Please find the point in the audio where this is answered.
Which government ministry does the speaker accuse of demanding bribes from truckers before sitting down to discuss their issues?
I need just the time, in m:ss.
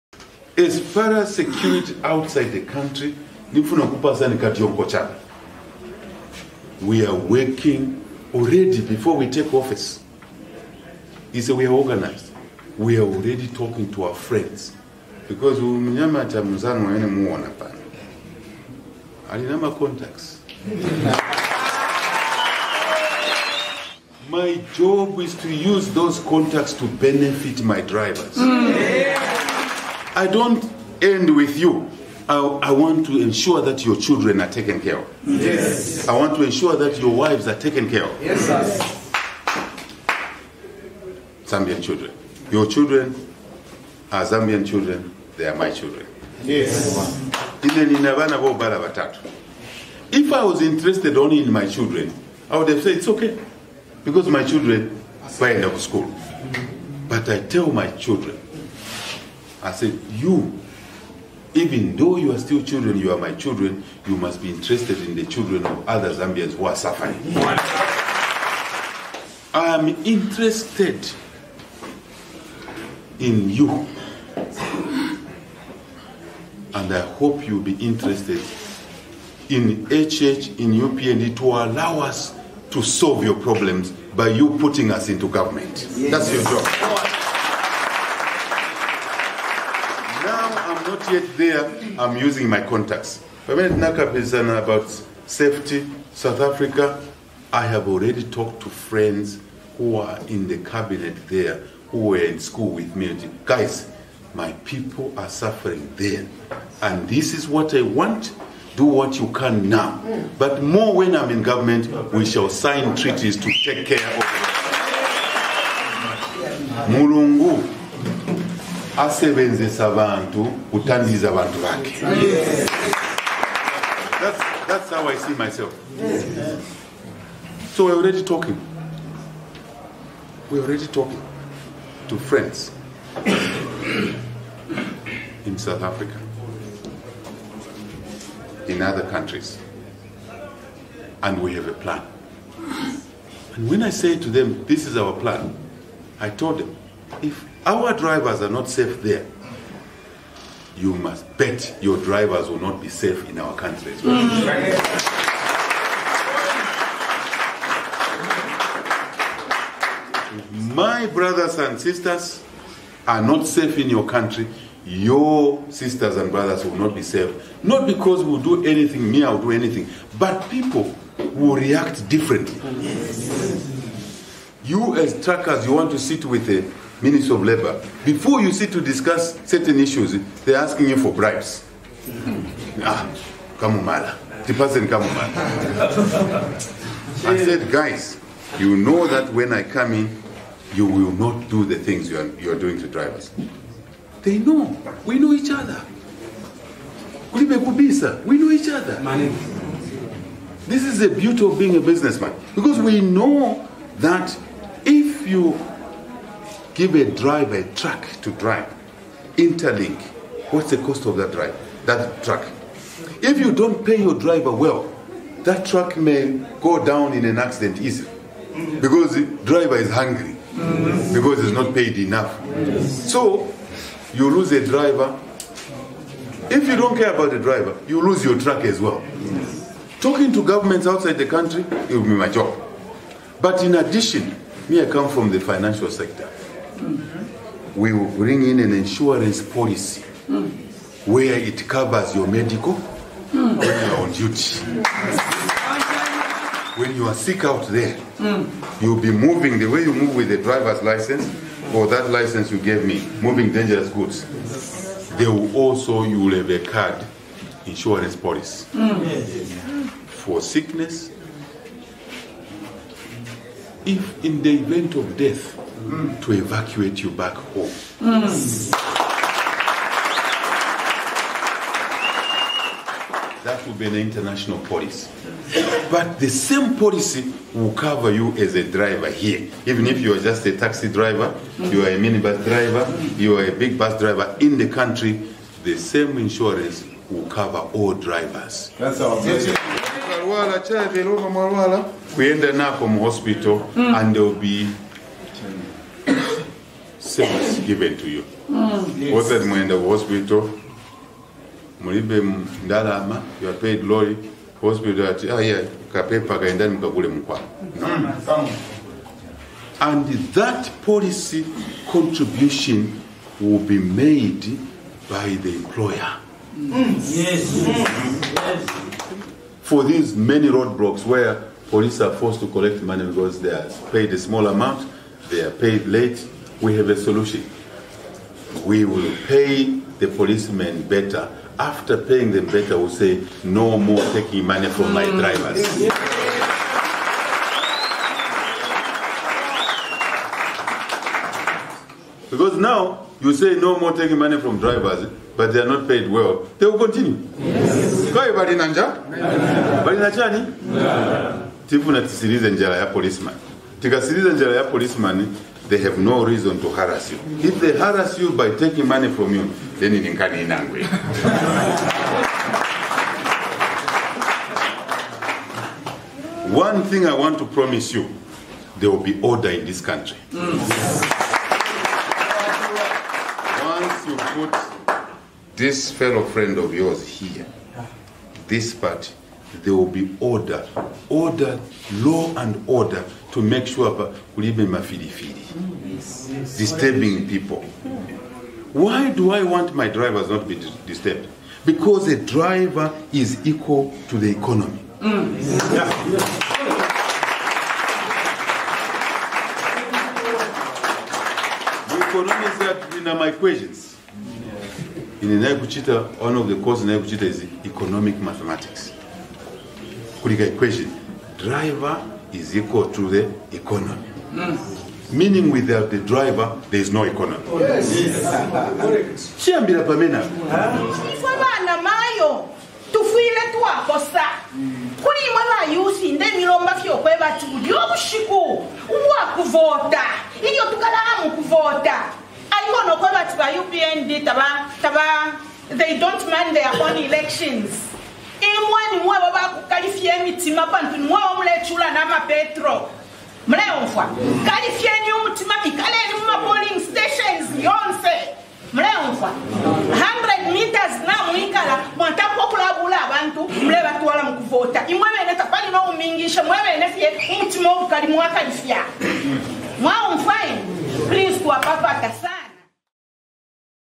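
2:57.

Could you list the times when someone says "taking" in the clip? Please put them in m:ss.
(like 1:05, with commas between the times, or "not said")
5:34, 5:43, 5:58.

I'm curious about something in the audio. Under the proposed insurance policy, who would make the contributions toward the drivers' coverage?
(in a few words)
The employer.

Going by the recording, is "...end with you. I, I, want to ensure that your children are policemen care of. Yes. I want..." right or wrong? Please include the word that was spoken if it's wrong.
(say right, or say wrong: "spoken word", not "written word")
wrong: "taken", not "policemen".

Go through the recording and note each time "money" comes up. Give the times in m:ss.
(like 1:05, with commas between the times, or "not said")
5:22, 5:34, 5:44, 5:58.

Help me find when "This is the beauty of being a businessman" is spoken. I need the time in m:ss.
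3:20.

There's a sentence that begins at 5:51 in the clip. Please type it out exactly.
Tifu na tisirize njala ya policeman.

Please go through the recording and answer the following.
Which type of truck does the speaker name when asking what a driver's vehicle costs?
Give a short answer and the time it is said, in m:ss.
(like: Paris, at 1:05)
Interlink, at 3:29.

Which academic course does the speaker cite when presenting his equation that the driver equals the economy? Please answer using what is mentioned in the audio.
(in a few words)
Economic mathematics.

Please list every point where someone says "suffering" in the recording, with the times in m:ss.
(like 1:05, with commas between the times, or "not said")
1:06, 1:45.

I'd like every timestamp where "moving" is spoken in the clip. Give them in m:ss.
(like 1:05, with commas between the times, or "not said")
4:09, 4:13.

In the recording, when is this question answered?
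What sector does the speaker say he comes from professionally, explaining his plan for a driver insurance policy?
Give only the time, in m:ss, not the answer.
3:55.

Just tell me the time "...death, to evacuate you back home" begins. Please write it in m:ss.
4:25.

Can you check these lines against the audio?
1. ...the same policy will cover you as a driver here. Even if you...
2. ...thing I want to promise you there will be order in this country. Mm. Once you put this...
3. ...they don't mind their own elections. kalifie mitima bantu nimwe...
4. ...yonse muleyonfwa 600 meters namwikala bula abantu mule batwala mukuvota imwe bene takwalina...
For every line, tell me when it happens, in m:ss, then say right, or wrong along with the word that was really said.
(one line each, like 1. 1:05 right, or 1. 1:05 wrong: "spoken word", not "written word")
1. 4:36 right
2. 6:06 right
3. 7:15 right
4. 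7:27 wrong: "100", not "600".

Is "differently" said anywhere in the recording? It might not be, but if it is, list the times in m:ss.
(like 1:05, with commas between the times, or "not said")
2:52.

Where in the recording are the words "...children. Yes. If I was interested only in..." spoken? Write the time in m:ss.
0:45.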